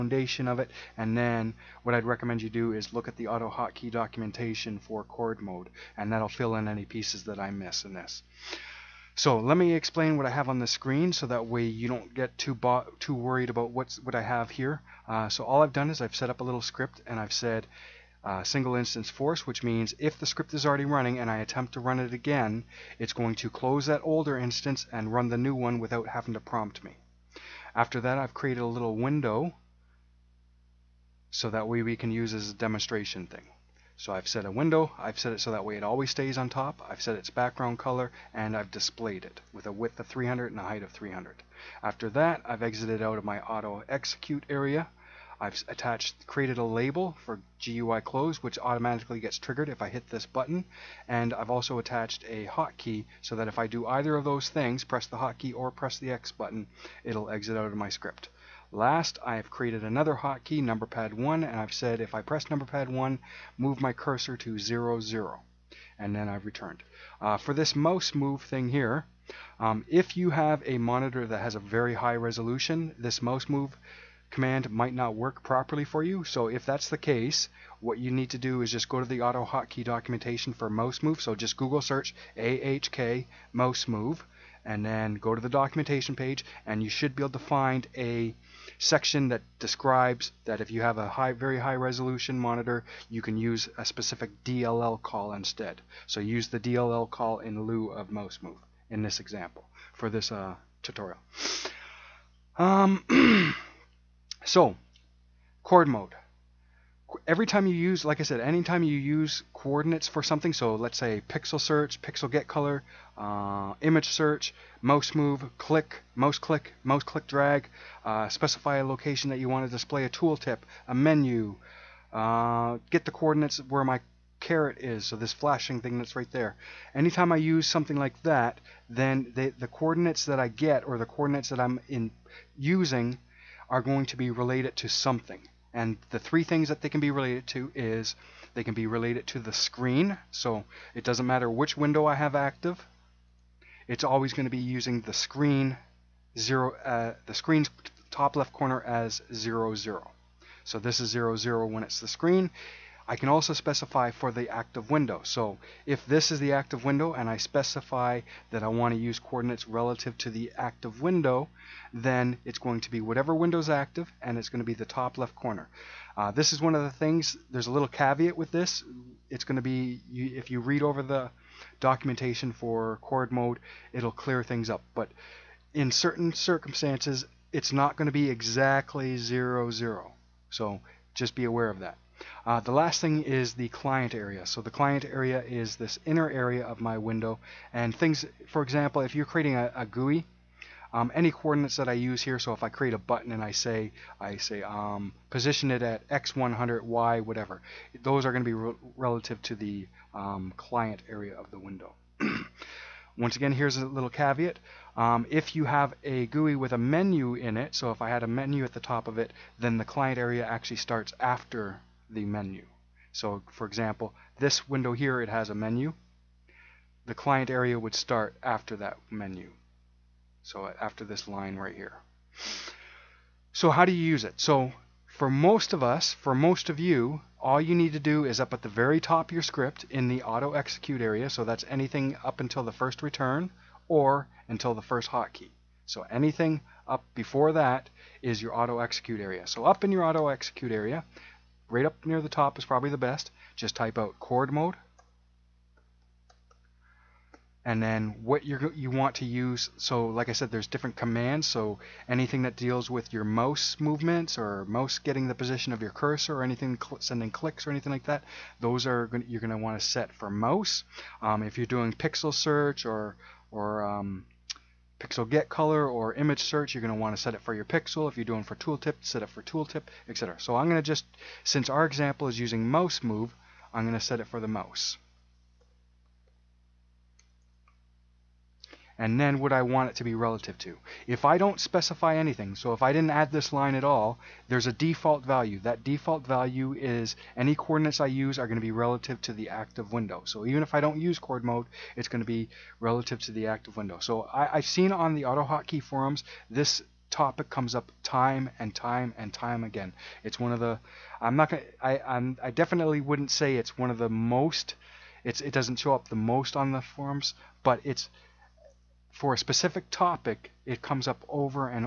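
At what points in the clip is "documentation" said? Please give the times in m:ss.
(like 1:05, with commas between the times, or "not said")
0:03, 1:19, 1:25, 2:51.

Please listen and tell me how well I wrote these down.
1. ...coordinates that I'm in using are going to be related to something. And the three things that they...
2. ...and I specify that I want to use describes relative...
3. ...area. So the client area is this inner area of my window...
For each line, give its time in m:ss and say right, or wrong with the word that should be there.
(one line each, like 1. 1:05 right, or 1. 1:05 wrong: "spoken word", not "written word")
1. 2:11 right
2. 2:37 wrong: "coordinates", not "describes"
3. 3:04 right.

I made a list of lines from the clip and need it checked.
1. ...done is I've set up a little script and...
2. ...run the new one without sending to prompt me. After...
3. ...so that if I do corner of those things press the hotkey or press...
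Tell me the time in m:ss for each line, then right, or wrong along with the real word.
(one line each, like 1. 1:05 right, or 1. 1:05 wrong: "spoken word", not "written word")
1. 0:15 right
2. 0:25 wrong: "having", not "sending"
3. 0:53 wrong: "either", not "corner".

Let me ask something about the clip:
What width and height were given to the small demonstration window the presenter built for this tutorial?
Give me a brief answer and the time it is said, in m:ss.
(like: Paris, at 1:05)
300 by 300, at 0:39.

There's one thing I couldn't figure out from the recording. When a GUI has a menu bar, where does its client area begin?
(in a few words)
after the menu.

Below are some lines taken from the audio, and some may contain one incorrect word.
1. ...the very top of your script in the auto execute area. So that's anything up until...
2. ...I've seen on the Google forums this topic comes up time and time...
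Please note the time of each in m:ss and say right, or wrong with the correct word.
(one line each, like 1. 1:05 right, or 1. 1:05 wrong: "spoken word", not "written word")
1. 3:48 right
2. 4:54 wrong: "AutoHotkey", not "Google".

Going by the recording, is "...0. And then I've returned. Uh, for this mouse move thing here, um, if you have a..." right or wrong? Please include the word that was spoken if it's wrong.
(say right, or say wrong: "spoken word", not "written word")
right.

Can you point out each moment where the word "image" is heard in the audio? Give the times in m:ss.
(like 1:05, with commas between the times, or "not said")
1:53, 4:26.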